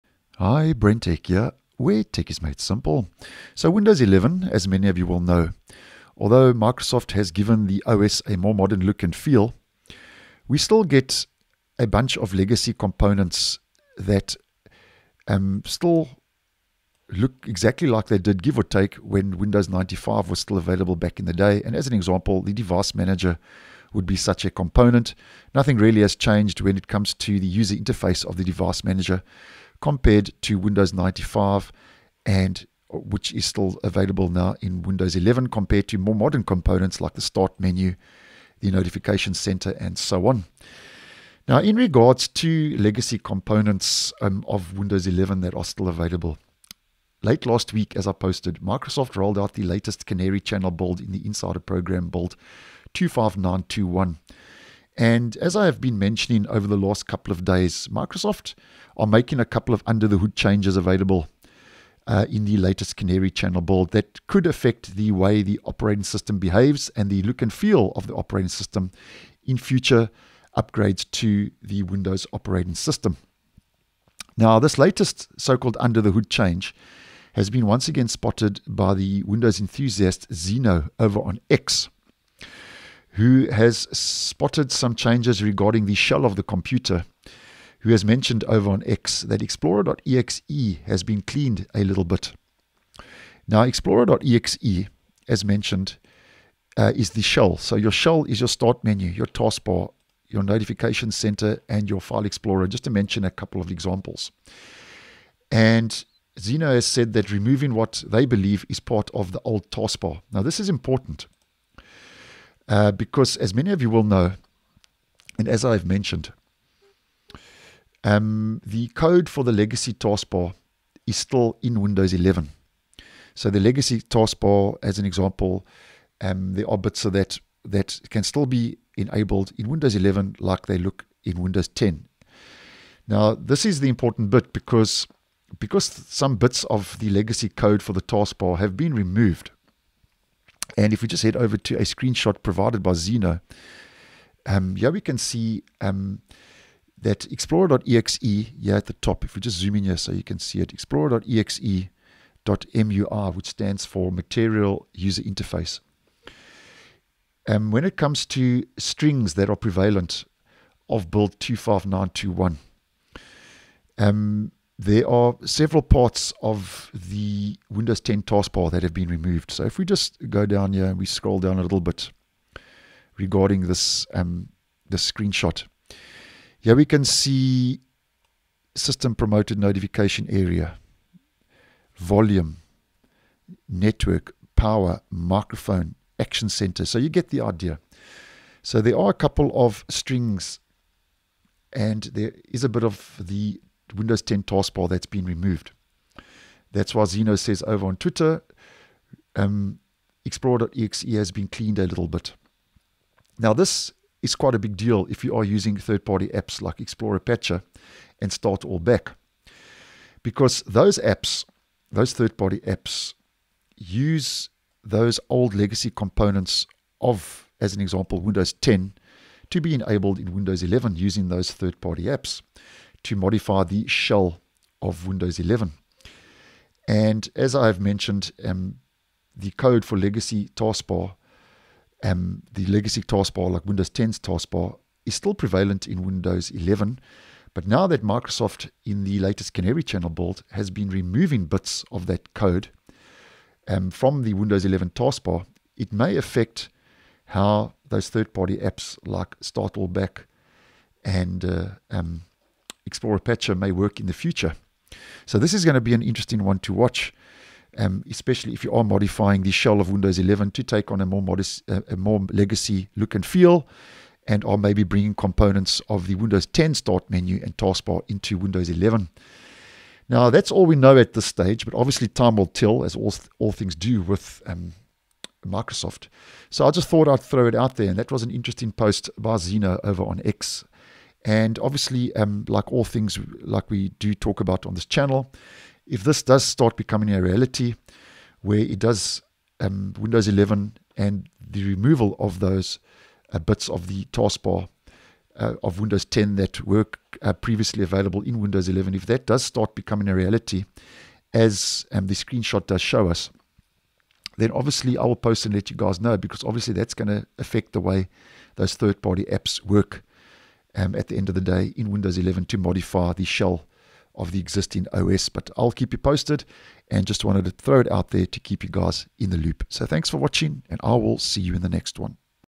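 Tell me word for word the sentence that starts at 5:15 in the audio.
But I'll keep you posted and just wanted to throw it out there to keep you guys in the loop.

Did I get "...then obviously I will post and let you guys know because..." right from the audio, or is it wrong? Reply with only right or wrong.
right.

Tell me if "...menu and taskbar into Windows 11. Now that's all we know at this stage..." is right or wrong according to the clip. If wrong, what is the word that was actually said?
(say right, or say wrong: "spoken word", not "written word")
right.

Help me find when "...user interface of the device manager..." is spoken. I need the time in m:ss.
0:27.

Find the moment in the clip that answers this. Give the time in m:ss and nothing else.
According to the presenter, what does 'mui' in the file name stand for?
2:34.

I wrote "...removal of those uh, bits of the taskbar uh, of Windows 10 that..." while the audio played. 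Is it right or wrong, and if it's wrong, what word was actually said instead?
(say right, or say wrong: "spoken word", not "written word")
right.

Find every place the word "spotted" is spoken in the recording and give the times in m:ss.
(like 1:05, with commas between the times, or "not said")
1:18, 1:23.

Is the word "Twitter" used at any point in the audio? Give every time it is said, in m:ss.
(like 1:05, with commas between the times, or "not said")
3:17.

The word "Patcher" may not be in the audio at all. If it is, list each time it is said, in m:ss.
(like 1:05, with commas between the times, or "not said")
3:27, 4:13.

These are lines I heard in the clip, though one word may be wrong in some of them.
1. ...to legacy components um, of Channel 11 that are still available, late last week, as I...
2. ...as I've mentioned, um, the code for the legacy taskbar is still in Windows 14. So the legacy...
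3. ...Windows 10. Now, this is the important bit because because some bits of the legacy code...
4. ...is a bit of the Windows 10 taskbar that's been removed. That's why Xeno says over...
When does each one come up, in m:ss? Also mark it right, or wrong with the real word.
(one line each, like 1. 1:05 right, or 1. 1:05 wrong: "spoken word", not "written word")
1. 0:42 wrong: "Windows", not "Channel"
2. 1:55 wrong: "11", not "14"
3. 2:11 right
4. 3:12 right.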